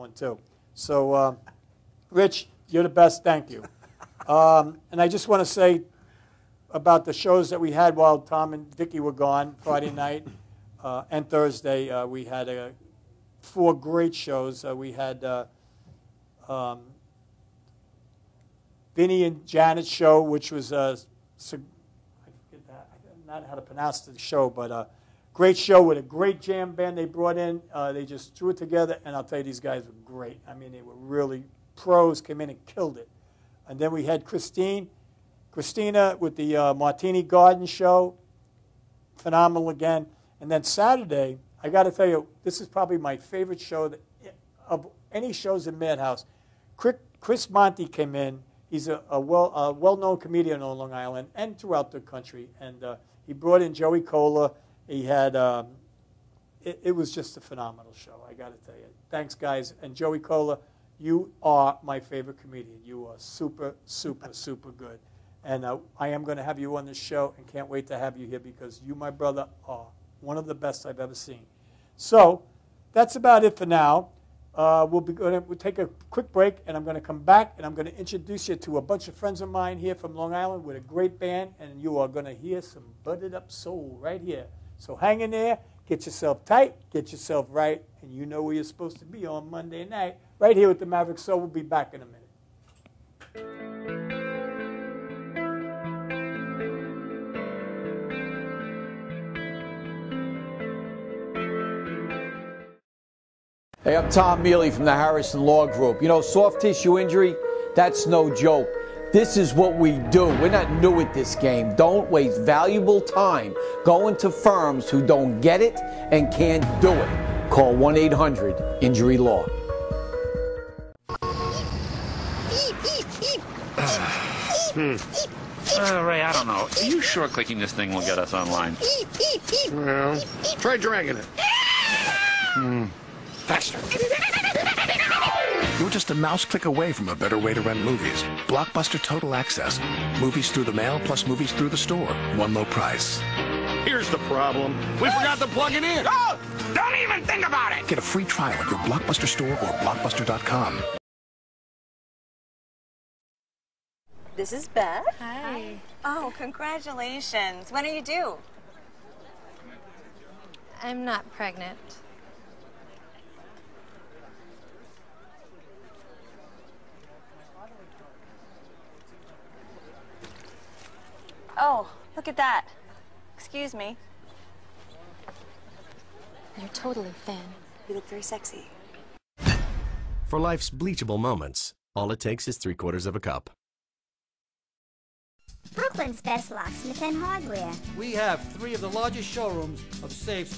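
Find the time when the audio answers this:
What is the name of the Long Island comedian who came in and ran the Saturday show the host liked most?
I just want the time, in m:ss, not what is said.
0:47.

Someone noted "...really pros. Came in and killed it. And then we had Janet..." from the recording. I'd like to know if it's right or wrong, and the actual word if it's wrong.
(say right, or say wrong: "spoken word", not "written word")
wrong: "Christine", not "Janet".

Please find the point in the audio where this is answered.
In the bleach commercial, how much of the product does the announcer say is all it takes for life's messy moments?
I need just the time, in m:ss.
3:02.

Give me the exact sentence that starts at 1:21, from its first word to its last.
And you are going to hear some budded up soul right here.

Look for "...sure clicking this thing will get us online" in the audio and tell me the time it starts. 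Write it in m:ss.
2:07.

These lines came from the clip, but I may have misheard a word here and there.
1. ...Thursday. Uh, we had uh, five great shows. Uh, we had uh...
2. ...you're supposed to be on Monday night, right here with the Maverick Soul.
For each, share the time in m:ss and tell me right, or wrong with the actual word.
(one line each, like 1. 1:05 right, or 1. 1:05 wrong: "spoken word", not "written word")
1. 0:11 wrong: "four", not "five"
2. 1:28 right.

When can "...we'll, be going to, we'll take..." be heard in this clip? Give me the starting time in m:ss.
1:14.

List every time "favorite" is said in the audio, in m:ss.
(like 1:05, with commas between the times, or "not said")
0:43, 1:01.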